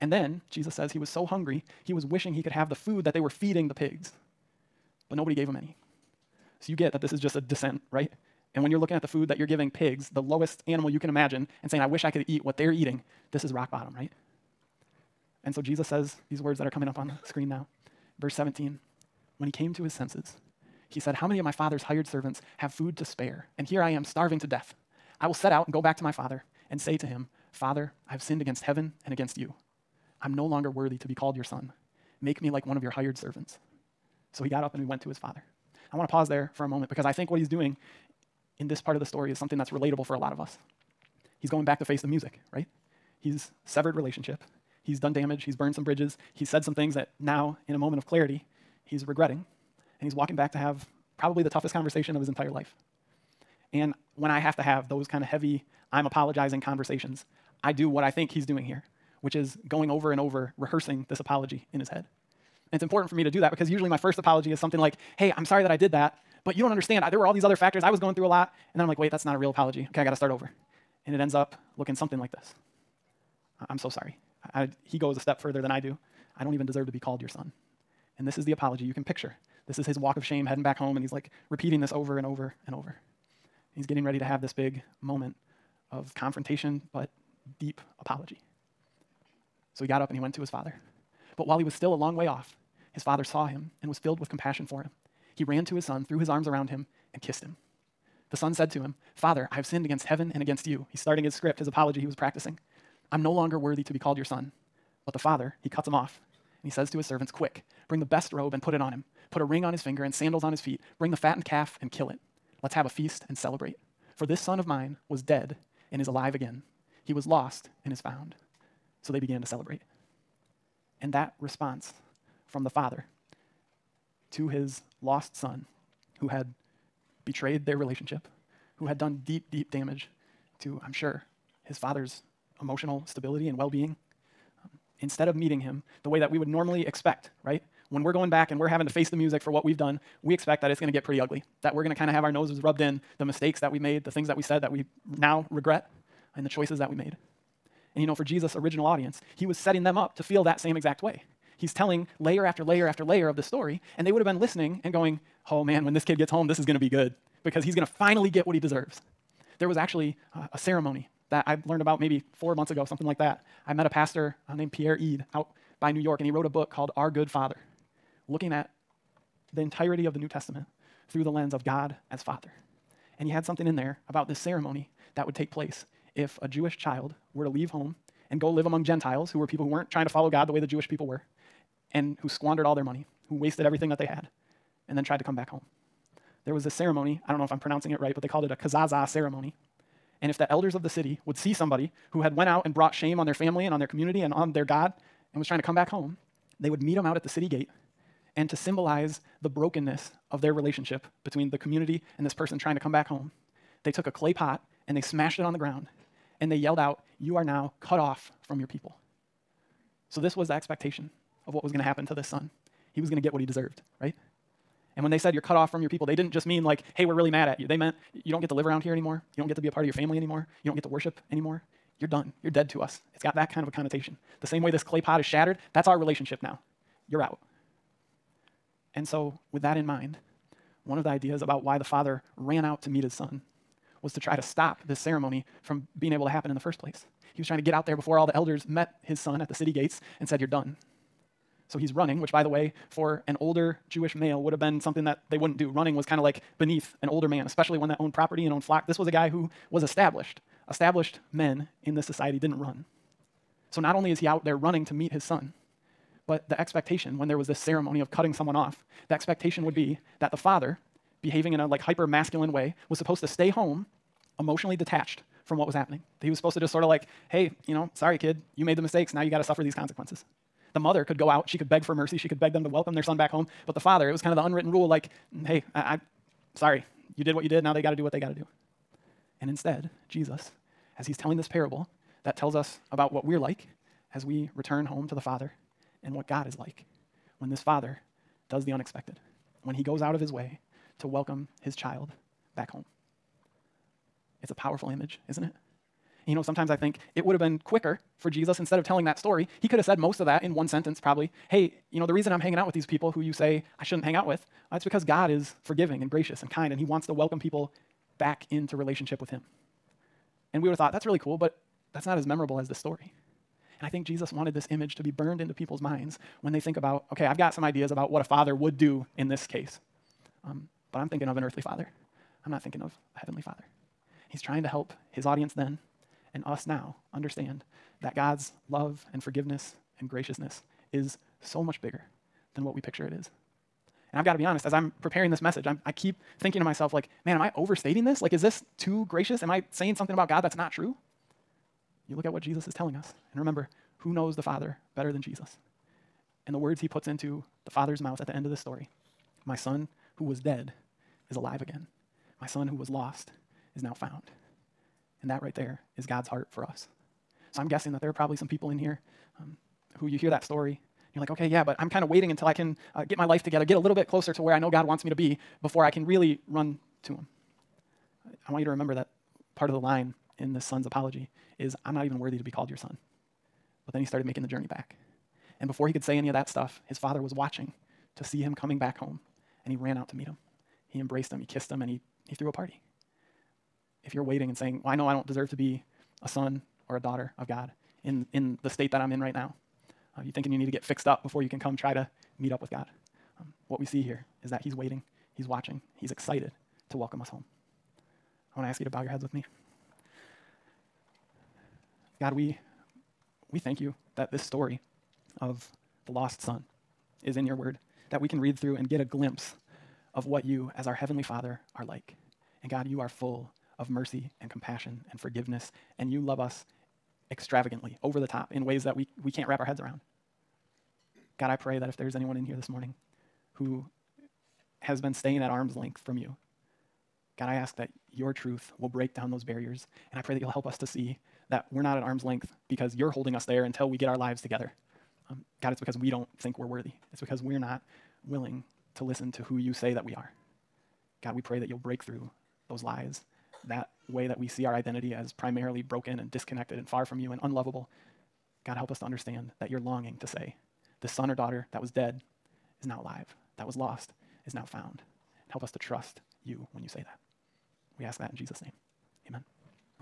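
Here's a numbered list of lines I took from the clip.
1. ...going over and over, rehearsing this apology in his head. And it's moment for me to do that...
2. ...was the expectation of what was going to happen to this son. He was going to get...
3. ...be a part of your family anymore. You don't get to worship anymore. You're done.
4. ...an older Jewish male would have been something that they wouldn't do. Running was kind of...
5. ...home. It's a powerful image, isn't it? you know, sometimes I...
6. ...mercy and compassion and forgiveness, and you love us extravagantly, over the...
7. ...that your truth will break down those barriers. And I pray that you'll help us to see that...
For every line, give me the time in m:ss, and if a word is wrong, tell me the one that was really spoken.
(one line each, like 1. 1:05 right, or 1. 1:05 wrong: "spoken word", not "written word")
1. 0:59 wrong: "important", not "moment"
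2. 3:30 right
3. 3:39 right
4. 4:03 right
5. 4:52 right
6. 6:53 right
7. 7:07 right.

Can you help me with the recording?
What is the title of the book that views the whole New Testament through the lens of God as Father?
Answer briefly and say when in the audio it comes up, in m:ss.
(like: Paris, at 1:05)
Our Good Father, at 2:46.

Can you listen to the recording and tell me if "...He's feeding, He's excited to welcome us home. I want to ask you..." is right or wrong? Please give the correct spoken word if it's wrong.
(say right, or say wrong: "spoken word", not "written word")
wrong: "watching", not "feeding".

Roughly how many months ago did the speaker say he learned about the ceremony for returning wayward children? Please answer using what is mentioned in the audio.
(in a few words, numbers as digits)
4.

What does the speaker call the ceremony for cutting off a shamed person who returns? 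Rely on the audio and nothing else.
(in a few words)
Kazaza.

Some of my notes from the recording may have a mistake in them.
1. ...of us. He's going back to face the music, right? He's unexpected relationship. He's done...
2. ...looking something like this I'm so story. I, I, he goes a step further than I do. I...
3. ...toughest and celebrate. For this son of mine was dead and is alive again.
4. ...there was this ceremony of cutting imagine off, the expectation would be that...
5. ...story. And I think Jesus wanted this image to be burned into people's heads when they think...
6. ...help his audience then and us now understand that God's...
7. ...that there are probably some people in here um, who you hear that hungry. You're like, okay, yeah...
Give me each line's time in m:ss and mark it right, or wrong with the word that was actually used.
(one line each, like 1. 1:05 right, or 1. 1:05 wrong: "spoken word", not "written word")
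1. 0:40 wrong: "severed", not "unexpected"
2. 1:11 wrong: "sorry", not "story"
3. 1:52 wrong: "feast", not "toughest"
4. 4:17 wrong: "someone", not "imagine"
5. 5:12 wrong: "minds", not "heads"
6. 5:24 right
7. 5:57 wrong: "story", not "hungry".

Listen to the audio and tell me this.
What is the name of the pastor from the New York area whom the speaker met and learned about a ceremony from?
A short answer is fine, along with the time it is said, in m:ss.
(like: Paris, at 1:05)
Pierre Ede, at 2:44.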